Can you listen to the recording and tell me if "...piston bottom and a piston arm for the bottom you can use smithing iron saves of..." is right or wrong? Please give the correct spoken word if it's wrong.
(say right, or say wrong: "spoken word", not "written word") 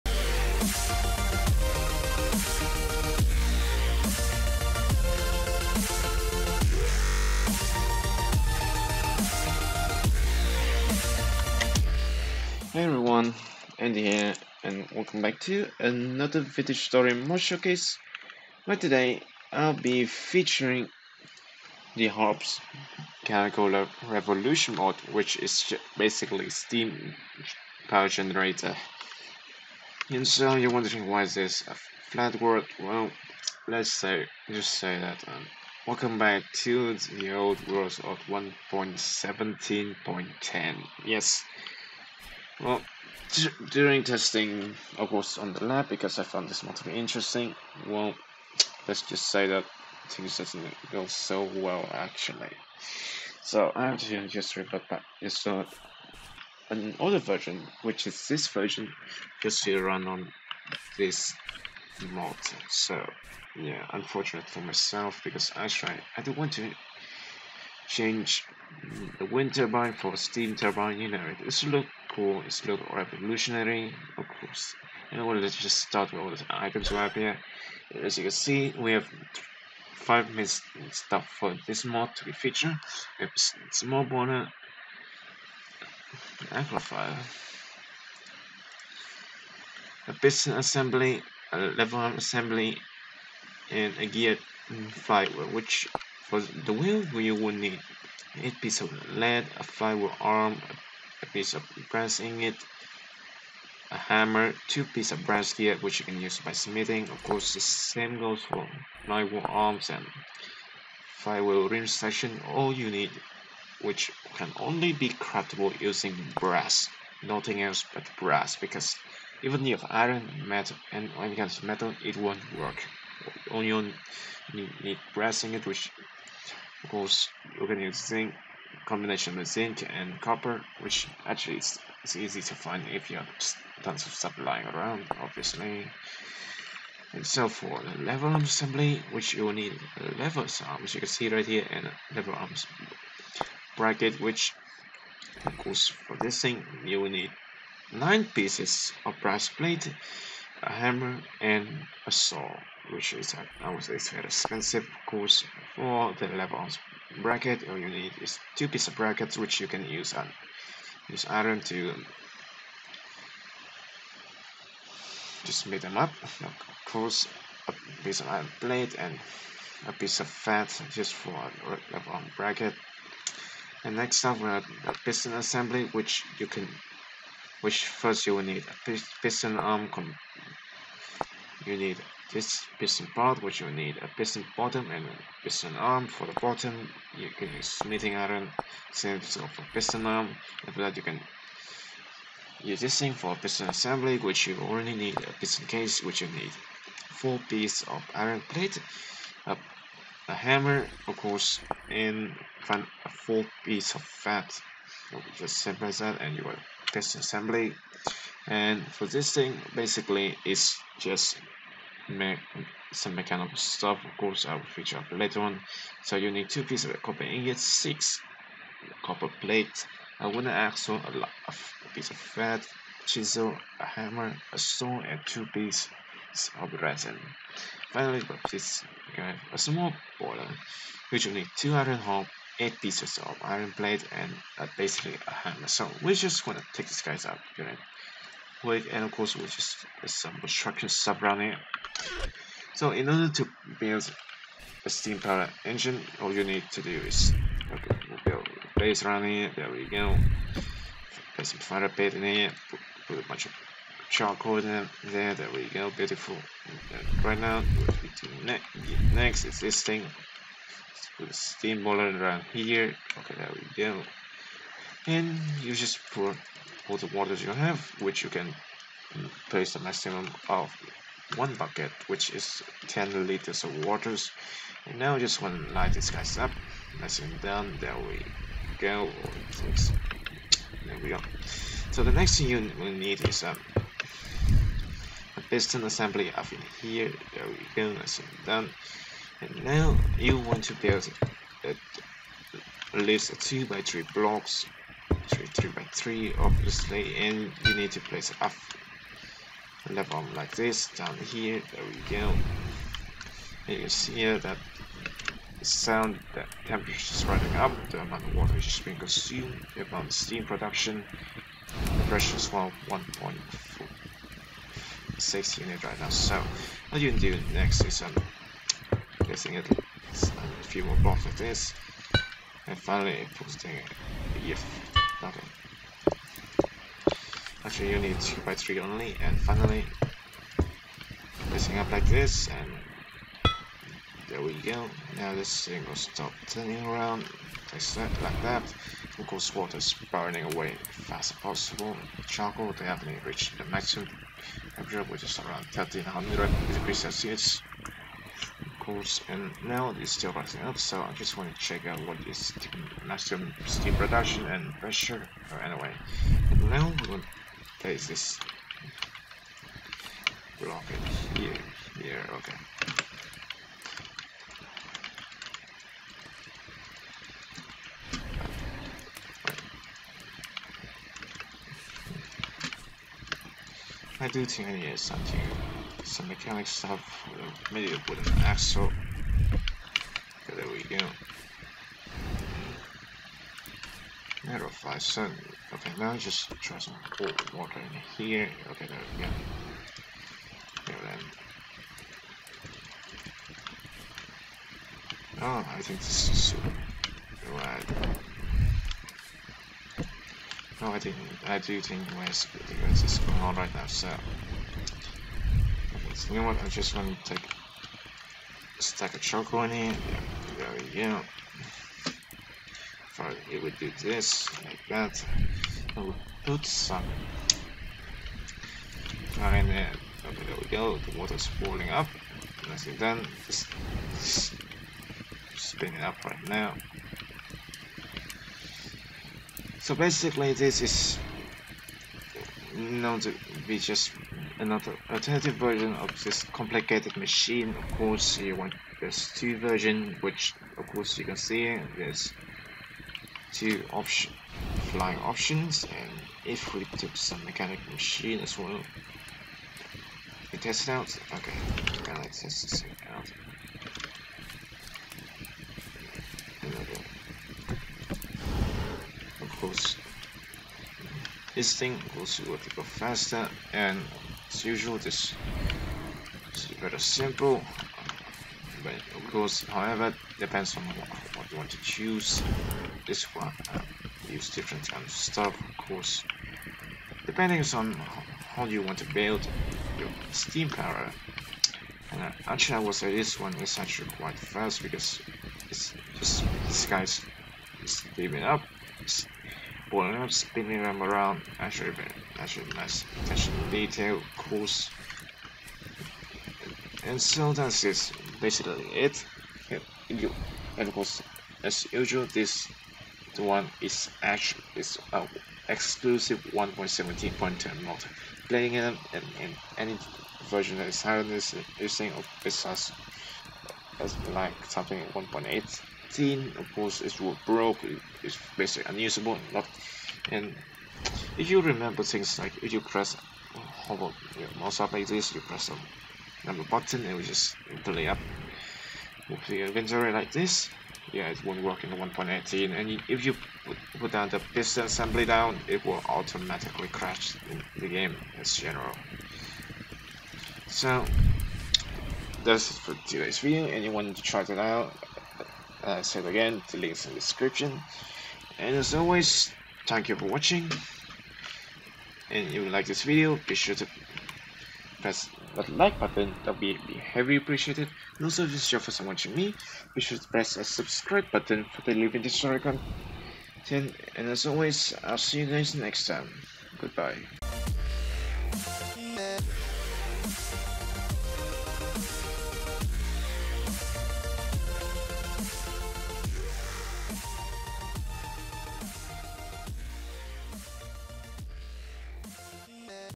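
right.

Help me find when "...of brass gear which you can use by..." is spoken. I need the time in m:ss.
1:45.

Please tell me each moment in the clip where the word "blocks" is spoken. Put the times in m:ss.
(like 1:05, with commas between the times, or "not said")
4:54, 5:20, 6:00.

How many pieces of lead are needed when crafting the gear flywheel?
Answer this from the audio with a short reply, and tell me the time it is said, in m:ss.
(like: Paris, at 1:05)
8, at 1:38.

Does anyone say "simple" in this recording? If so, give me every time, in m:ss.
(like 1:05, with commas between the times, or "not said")
3:25, 7:46.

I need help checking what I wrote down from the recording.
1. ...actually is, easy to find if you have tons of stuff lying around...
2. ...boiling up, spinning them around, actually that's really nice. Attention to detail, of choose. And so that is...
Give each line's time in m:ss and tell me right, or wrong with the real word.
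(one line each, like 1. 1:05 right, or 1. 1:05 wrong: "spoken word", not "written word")
1. 2:11 right
2. 8:09 wrong: "course", not "choose".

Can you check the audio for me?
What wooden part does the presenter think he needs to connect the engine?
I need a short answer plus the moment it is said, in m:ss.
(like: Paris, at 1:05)
Wooden axle, at 6:18.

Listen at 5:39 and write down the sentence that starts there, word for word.
Of course water is burning away as fast as possible.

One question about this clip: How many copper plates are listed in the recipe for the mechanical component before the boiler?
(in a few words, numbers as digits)
6.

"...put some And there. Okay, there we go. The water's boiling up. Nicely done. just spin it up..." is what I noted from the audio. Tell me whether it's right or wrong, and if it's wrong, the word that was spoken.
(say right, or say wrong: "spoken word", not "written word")
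right.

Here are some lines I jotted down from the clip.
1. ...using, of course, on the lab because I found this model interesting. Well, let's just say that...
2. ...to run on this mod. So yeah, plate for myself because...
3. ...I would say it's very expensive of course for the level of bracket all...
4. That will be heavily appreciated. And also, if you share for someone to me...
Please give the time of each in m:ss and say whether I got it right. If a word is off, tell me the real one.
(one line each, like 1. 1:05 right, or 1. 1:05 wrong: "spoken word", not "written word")
1. 0:44 wrong: "testing", not "using"
2. 0:59 wrong: "unfortunate", not "plate"
3. 2:33 right
4. 9:16 right.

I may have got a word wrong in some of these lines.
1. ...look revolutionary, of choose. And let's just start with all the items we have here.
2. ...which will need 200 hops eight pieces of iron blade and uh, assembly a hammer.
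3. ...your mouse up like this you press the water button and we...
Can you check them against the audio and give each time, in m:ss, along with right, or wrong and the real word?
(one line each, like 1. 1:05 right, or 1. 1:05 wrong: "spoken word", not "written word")
1. 1:12 wrong: "course", not "choose"
2. 3:51 wrong: "basically", not "assembly"
3. 8:44 wrong: "number", not "water".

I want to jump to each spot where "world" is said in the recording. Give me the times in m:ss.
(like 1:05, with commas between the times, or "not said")
0:32, 0:37.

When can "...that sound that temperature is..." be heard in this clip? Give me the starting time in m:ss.
5:04.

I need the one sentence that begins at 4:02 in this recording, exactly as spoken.
So in order to build a steam power engine, all you need to do is okay, we'll build a base around here.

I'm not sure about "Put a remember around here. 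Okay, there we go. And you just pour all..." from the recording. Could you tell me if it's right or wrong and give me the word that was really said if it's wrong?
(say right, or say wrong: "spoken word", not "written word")
wrong: "boiler", not "remember".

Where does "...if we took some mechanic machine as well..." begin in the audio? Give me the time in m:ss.
7:26.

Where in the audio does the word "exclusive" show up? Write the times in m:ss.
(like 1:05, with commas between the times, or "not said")
8:25.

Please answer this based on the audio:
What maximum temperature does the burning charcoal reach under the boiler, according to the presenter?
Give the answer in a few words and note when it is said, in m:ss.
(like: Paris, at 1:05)
1300 degrees Celsius, at 5:45.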